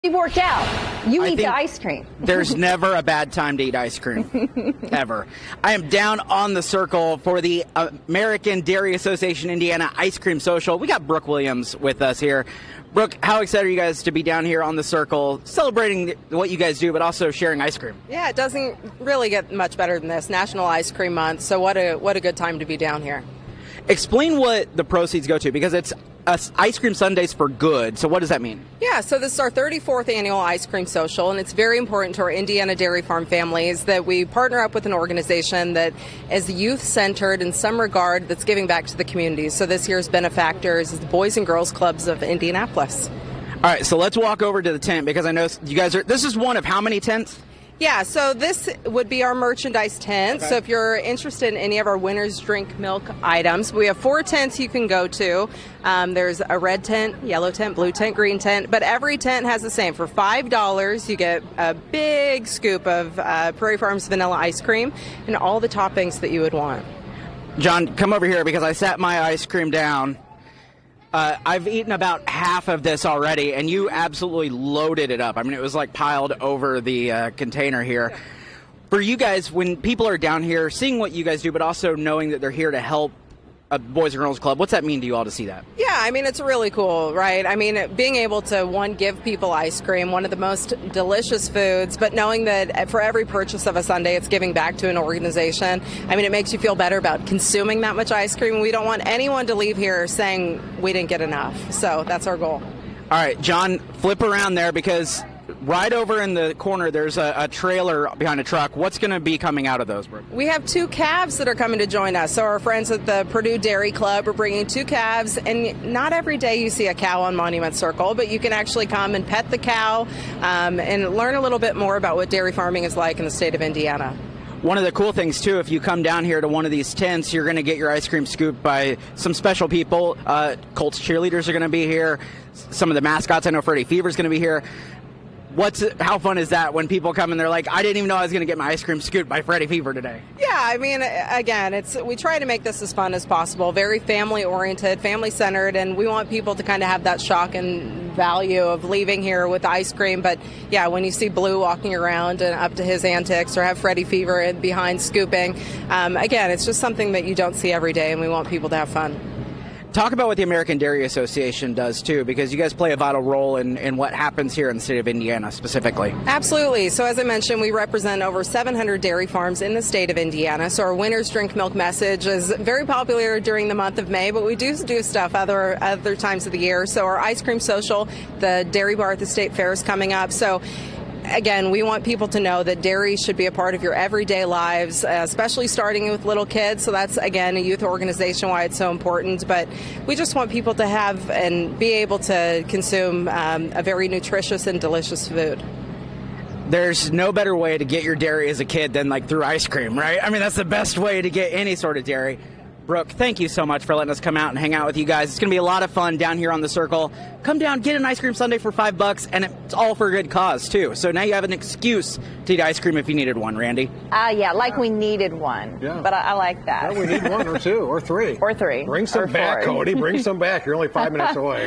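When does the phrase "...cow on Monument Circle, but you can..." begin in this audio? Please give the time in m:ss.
1:56.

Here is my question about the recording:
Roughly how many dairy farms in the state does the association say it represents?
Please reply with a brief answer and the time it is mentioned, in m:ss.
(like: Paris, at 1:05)
over 700, at 2:48.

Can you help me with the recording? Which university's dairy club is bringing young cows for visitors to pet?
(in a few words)
Purdue.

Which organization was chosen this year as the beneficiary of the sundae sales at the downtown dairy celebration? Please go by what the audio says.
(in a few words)
Boys and Girls Clubs of Indianapolis.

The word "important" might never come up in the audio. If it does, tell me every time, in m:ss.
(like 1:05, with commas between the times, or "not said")
0:31, 3:08.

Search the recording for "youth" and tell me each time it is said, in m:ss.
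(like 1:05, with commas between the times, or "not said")
0:36, 3:07.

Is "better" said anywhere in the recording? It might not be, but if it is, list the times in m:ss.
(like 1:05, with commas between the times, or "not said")
0:19, 1:36, 3:17.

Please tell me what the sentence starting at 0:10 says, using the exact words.
We got Brooke Williams with us here.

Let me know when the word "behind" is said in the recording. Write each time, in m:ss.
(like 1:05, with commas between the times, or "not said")
1:48, 2:34.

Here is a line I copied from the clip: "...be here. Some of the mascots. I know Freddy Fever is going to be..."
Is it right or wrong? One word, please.
right.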